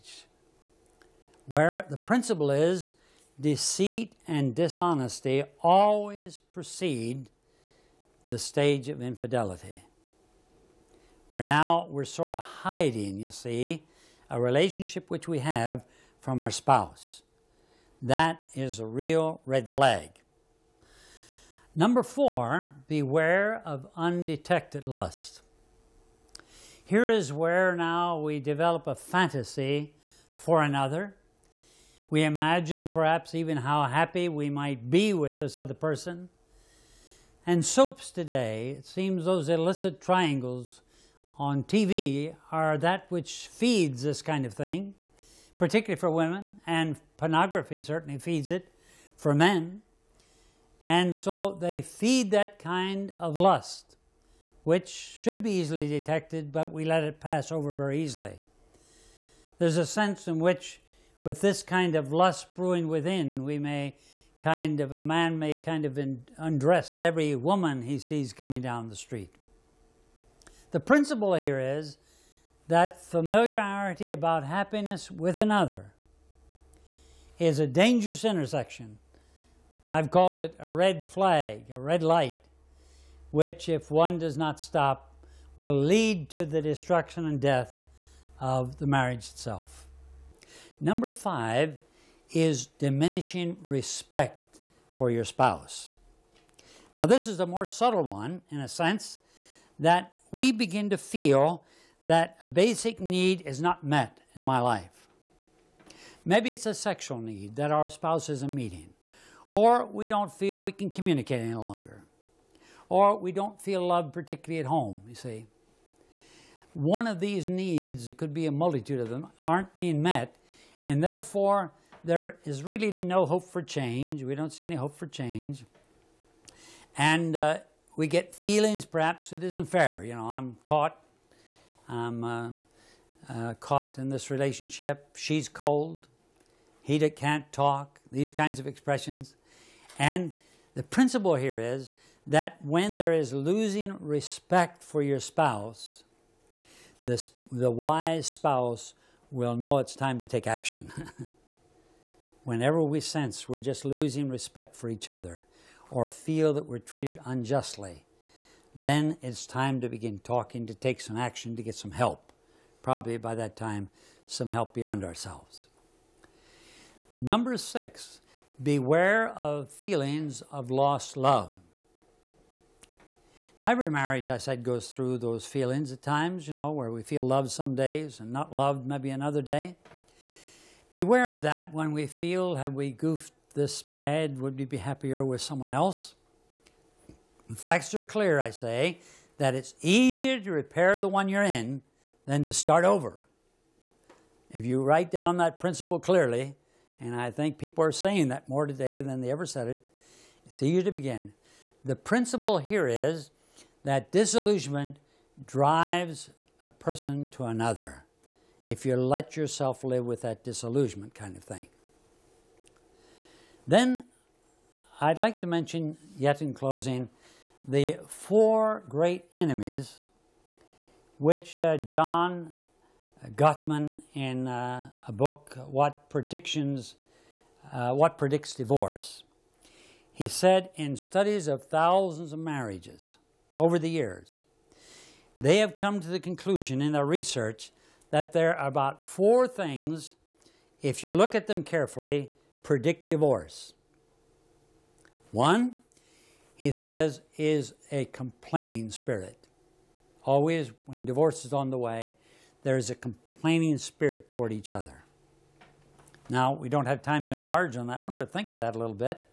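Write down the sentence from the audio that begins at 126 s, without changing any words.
And uh, we get feelings, perhaps it isn't fair.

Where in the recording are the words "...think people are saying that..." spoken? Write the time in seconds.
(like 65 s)
197 s.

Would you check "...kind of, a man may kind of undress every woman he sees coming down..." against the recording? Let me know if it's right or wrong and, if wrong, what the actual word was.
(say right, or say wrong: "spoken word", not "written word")
right.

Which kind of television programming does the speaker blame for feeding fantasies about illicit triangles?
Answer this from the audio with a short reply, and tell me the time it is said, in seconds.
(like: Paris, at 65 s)
Soaps, at 37 s.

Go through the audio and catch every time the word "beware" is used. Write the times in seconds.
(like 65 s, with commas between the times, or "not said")
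22 s, 168 s, 180 s.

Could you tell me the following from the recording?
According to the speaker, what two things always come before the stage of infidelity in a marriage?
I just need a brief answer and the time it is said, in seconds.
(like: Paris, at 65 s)
Deceit and dishonesty, at 3 s.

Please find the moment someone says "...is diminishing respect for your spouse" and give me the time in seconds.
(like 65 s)
92 s.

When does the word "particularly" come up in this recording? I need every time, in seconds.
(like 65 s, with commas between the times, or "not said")
45 s, 114 s.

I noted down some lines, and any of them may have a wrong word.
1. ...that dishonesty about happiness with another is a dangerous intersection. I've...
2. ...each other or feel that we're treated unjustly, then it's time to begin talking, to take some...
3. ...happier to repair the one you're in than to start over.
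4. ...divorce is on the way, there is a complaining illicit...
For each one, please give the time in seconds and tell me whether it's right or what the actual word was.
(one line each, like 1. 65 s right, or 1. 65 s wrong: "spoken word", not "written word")
1. 72 s wrong: "familiarity", not "dishonesty"
2. 154 s right
3. 189 s wrong: "easier", not "happier"
4. 251 s wrong: "spirit", not "illicit".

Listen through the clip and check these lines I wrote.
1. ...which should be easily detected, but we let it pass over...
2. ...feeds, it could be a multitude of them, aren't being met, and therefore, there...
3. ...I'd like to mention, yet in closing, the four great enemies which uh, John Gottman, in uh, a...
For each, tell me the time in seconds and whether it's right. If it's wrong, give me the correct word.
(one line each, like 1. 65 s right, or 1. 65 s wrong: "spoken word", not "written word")
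1. 54 s right
2. 117 s wrong: "needs", not "feeds"
3. 215 s right.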